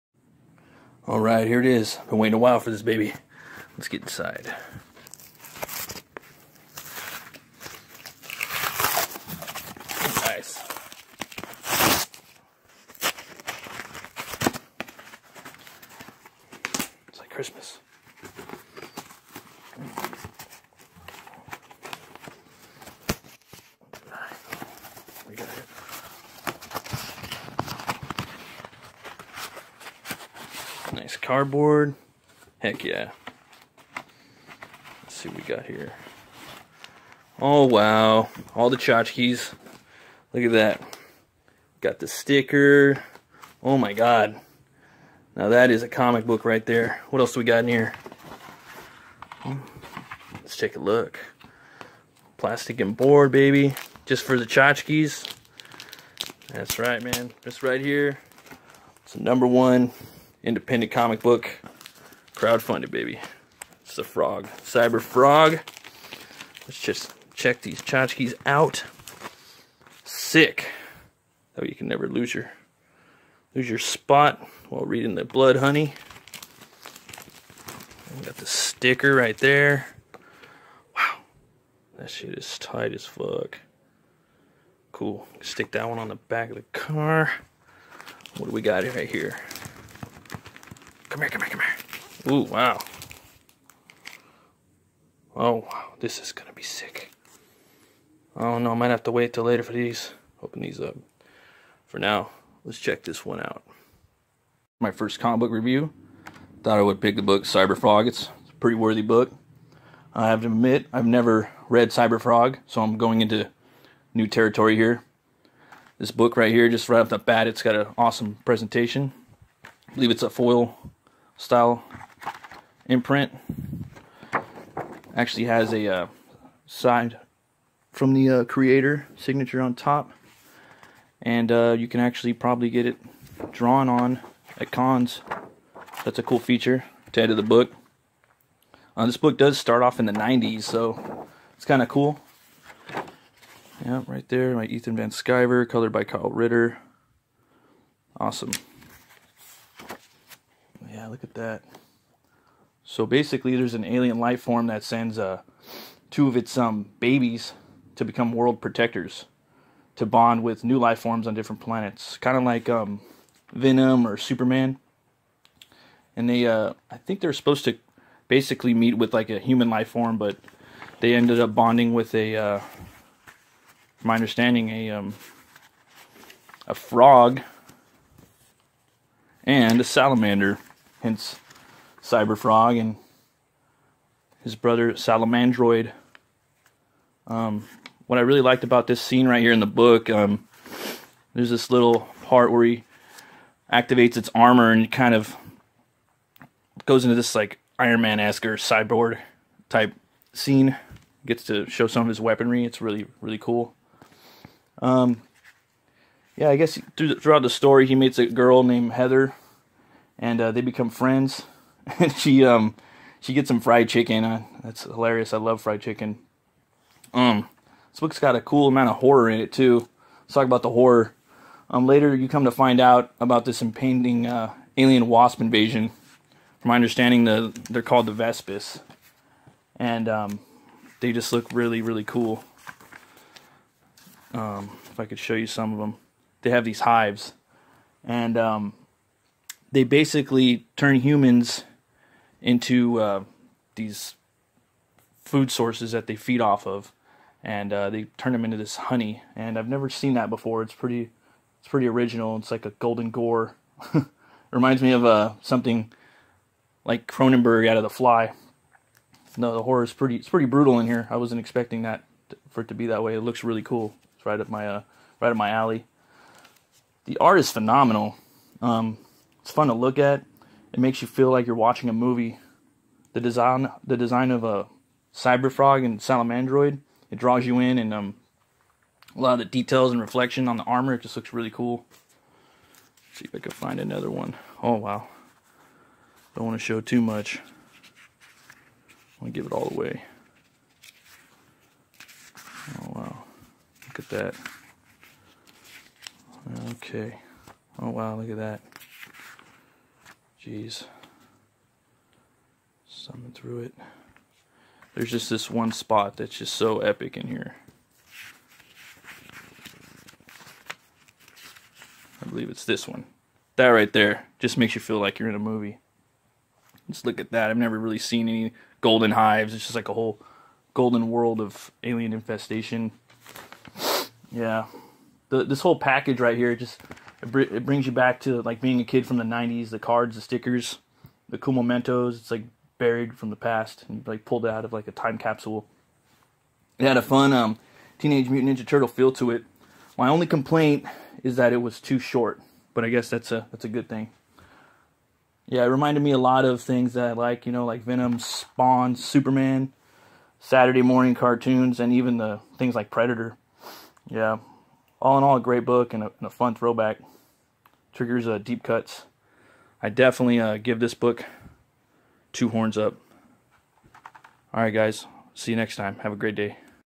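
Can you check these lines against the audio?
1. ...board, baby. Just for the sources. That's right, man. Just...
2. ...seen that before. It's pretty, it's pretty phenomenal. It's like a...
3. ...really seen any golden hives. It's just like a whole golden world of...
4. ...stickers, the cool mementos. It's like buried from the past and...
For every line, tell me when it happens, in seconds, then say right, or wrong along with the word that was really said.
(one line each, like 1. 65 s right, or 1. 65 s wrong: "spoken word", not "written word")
1. 52 s wrong: "tchotchkes", not "sources"
2. 249 s wrong: "original", not "phenomenal"
3. 317 s right
4. 330 s right.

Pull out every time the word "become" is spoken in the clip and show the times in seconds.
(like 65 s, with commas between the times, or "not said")
158 s, 210 s.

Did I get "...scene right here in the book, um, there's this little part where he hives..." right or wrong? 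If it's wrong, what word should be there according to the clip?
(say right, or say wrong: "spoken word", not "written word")
wrong: "activates", not "hives".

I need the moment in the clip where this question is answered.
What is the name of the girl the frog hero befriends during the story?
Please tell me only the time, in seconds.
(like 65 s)
208 s.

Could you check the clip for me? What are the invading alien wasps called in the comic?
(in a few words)
Vespis.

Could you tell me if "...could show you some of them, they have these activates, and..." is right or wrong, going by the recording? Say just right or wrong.
wrong.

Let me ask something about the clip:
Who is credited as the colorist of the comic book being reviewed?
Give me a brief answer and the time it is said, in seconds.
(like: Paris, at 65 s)
Kyle Ritter, at 146 s.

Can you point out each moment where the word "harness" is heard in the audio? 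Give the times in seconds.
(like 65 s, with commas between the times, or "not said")
not said.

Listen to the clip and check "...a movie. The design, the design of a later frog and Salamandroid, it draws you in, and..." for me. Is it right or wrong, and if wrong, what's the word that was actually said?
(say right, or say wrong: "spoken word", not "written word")
wrong: "cyber", not "later".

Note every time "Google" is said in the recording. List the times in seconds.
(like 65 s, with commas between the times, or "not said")
not said.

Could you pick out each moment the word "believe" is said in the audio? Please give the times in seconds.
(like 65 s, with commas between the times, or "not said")
119 s, 312 s.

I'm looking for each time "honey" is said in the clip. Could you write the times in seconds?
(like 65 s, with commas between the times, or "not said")
75 s, 248 s.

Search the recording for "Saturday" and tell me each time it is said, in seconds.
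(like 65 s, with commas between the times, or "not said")
350 s.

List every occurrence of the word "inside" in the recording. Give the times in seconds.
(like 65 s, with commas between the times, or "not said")
4 s.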